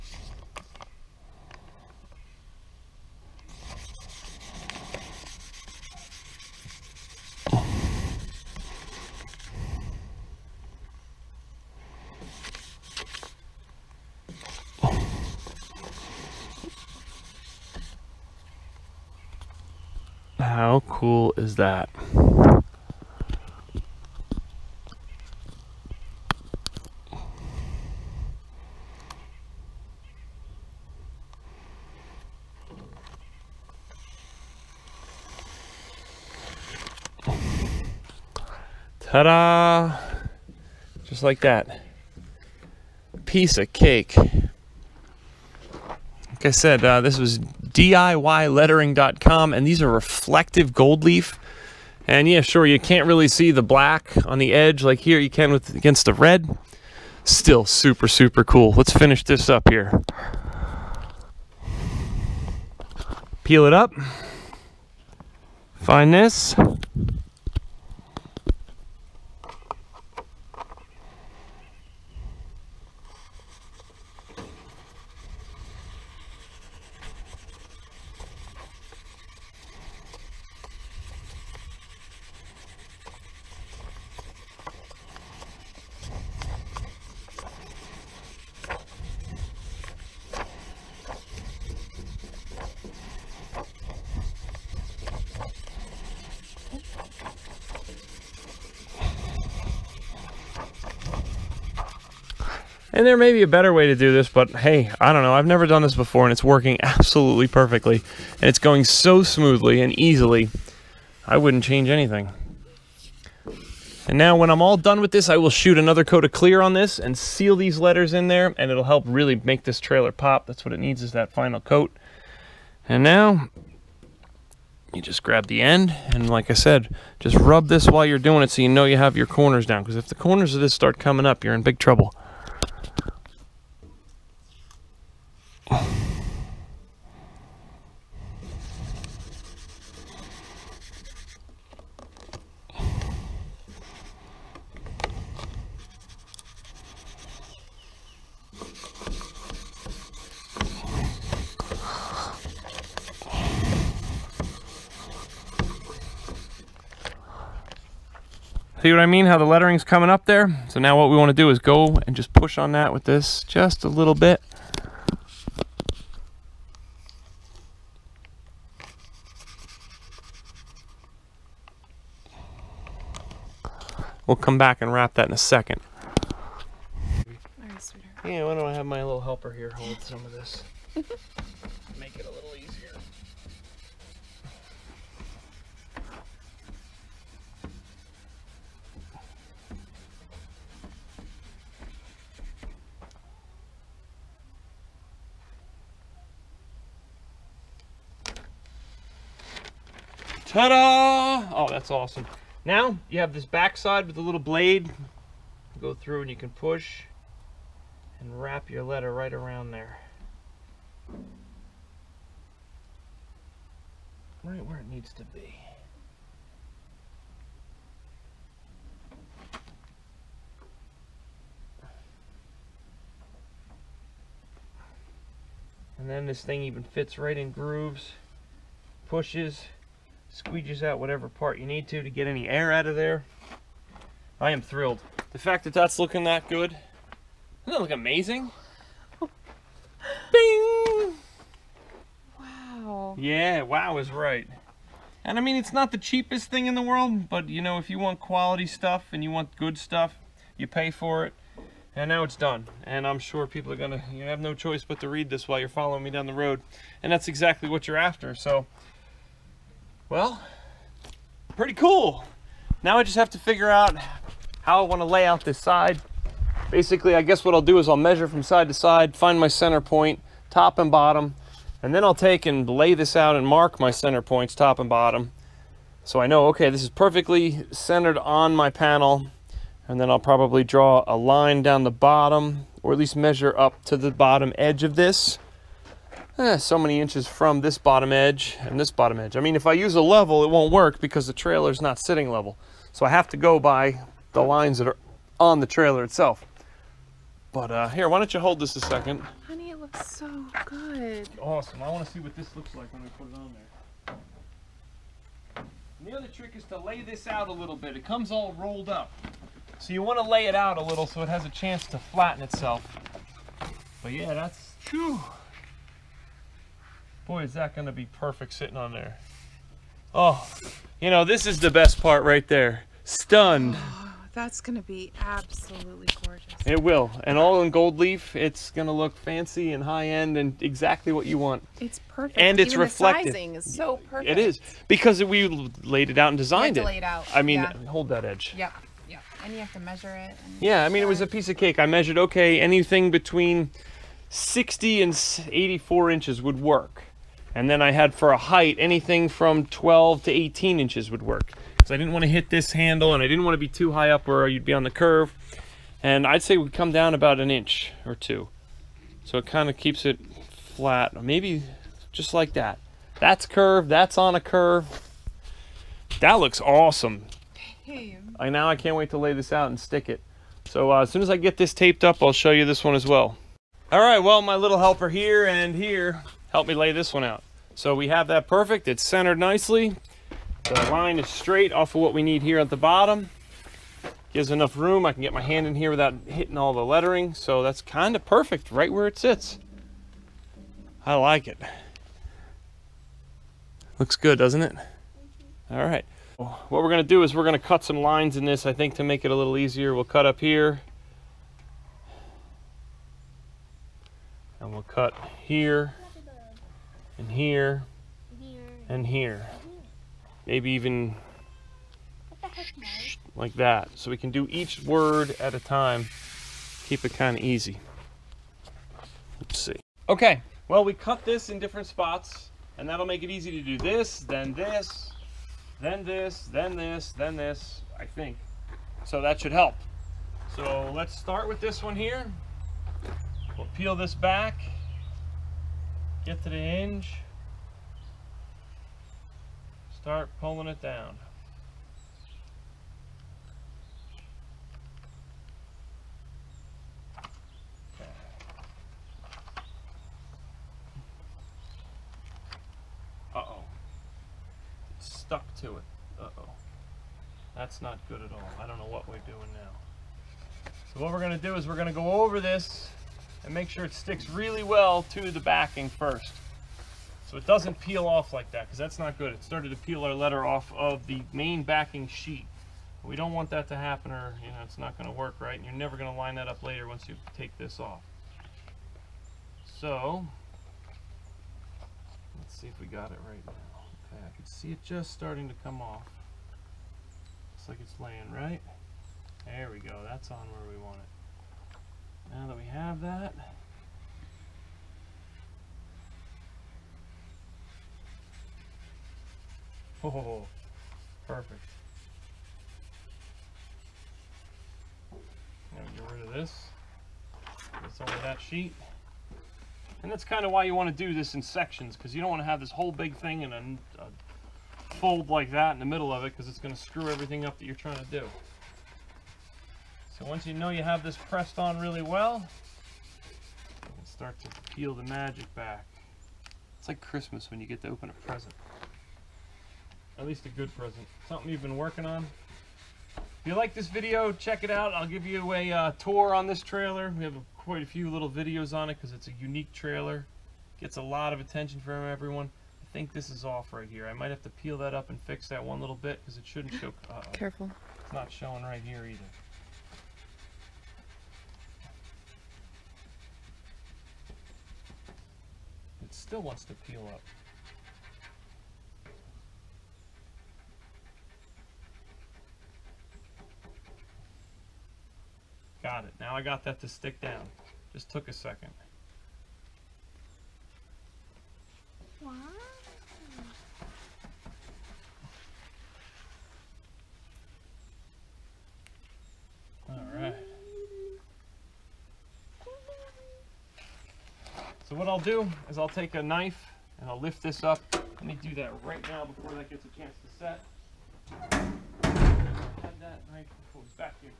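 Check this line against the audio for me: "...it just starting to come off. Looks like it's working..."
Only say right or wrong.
wrong.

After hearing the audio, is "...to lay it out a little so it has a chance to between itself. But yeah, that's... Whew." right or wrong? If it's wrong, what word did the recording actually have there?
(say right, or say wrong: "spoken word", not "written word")
wrong: "flatten", not "between".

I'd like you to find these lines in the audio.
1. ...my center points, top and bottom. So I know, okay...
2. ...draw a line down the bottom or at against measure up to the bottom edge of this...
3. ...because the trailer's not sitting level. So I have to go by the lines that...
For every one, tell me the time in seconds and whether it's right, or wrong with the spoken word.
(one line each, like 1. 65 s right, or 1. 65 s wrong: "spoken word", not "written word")
1. 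273 s right
2. 280 s wrong: "least", not "against"
3. 290 s right.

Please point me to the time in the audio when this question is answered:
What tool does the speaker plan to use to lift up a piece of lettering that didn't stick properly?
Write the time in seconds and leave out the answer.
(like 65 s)
586 s.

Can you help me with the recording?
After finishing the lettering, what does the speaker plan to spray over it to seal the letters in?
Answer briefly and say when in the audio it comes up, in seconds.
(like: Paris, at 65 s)
another coat of clear, at 115 s.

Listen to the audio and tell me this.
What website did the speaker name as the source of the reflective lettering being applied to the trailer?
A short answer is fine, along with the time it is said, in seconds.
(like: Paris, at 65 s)
DIYlettering.com, at 47 s.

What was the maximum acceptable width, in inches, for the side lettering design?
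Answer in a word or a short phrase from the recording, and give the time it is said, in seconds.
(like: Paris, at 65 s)
84 inches, at 345 s.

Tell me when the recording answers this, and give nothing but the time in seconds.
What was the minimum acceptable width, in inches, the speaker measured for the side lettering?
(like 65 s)
344 s.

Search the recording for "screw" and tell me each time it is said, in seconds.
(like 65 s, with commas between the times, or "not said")
516 s.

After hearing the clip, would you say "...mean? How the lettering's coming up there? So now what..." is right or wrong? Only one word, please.
right.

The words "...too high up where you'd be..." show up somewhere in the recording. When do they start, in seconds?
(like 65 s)
353 s.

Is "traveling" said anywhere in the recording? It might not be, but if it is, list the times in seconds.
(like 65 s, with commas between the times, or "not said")
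not said.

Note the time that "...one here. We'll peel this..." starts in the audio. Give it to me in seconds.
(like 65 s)
431 s.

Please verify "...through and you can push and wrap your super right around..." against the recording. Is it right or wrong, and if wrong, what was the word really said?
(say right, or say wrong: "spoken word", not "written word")
wrong: "letter", not "super".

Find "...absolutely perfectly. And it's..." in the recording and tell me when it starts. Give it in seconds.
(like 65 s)
106 s.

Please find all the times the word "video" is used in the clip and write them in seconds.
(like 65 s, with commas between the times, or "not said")
533 s, 538 s.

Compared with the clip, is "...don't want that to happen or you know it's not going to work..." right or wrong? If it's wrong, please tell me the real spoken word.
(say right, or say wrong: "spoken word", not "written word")
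right.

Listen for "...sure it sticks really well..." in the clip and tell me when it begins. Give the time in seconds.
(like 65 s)
463 s.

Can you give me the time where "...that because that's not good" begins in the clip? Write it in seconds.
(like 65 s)
468 s.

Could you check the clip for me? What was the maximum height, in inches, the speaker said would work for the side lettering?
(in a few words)
18 inches.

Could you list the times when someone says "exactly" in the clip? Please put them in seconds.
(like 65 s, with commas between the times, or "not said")
257 s, 330 s.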